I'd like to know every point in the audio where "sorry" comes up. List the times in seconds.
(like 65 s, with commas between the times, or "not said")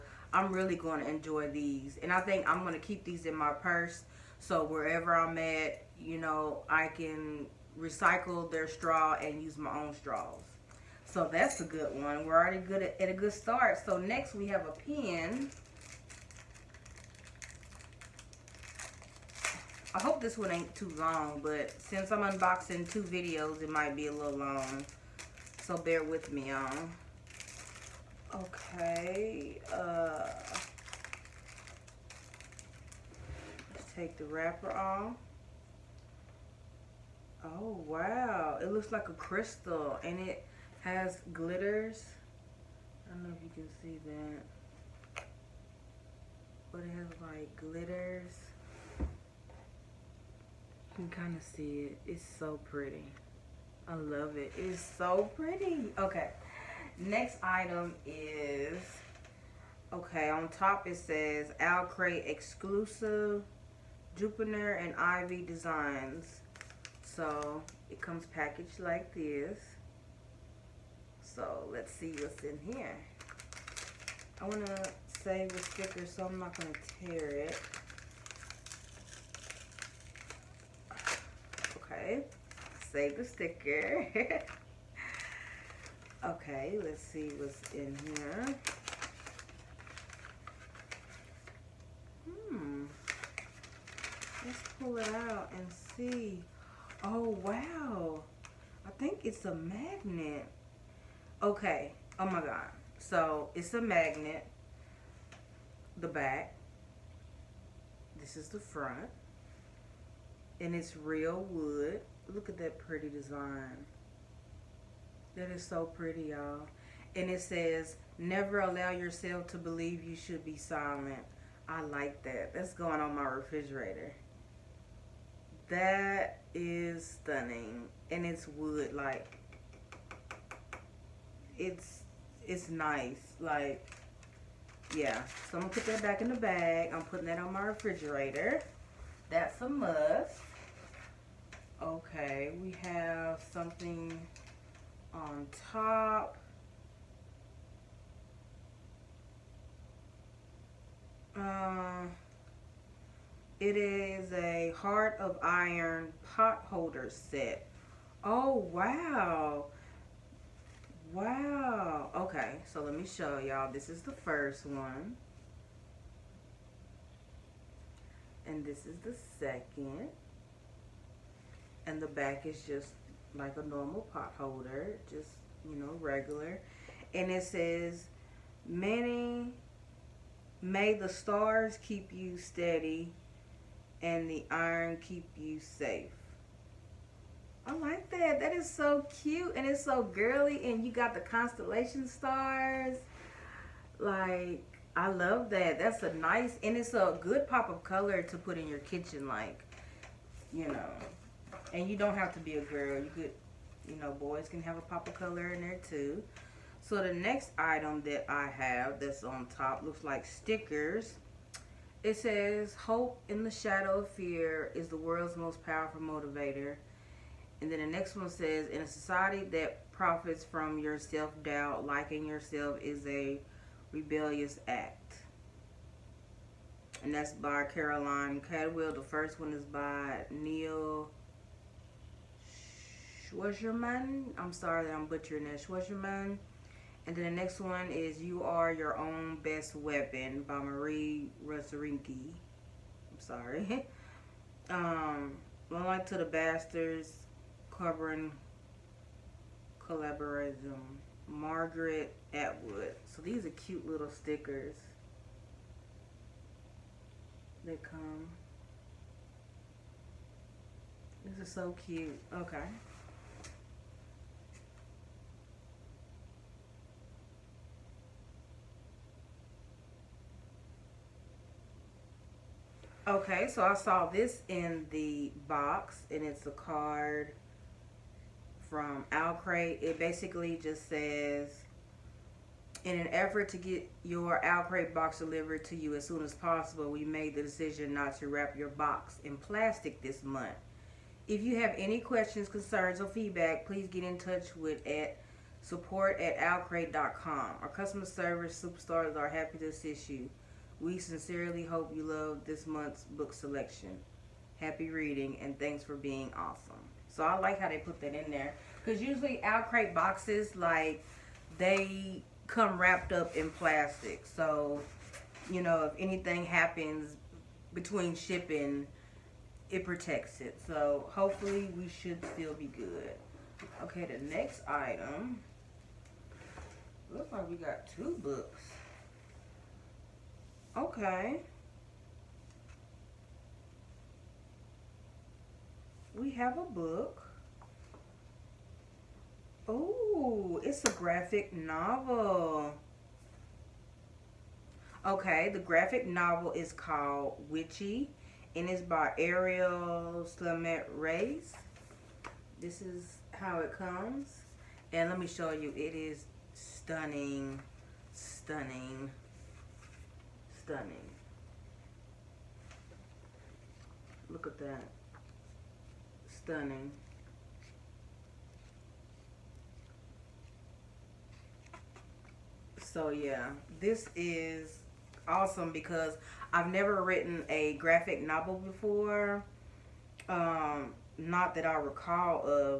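234 s, 243 s.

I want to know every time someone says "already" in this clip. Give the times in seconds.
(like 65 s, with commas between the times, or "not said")
12 s.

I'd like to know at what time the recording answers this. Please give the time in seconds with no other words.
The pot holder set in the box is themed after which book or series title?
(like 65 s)
154 s.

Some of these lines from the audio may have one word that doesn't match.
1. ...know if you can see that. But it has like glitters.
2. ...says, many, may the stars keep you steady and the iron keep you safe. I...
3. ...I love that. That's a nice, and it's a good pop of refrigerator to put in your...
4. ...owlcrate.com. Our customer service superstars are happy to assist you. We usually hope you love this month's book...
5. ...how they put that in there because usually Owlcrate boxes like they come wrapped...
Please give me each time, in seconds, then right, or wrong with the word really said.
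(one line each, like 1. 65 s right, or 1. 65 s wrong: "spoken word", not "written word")
1. 43 s right
2. 177 s right
3. 194 s wrong: "color", not "refrigerator"
4. 296 s wrong: "sincerely", not "usually"
5. 307 s right.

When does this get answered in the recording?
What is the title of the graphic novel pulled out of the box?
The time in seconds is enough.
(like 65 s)
347 s.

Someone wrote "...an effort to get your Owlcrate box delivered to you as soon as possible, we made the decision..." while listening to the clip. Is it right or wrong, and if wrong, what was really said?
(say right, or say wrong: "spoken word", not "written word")
right.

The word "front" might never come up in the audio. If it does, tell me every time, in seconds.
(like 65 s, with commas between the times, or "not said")
108 s.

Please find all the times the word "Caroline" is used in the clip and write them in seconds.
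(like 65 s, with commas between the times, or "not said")
227 s.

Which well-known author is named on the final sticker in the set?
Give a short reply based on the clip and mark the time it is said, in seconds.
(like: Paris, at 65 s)
Margaret Atwood, at 251 s.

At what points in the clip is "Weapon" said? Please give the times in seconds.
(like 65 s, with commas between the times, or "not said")
239 s.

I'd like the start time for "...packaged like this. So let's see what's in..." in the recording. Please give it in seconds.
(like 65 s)
68 s.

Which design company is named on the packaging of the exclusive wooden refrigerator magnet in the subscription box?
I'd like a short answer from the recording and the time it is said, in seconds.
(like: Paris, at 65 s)
Jupiter and Ivy Designs, at 64 s.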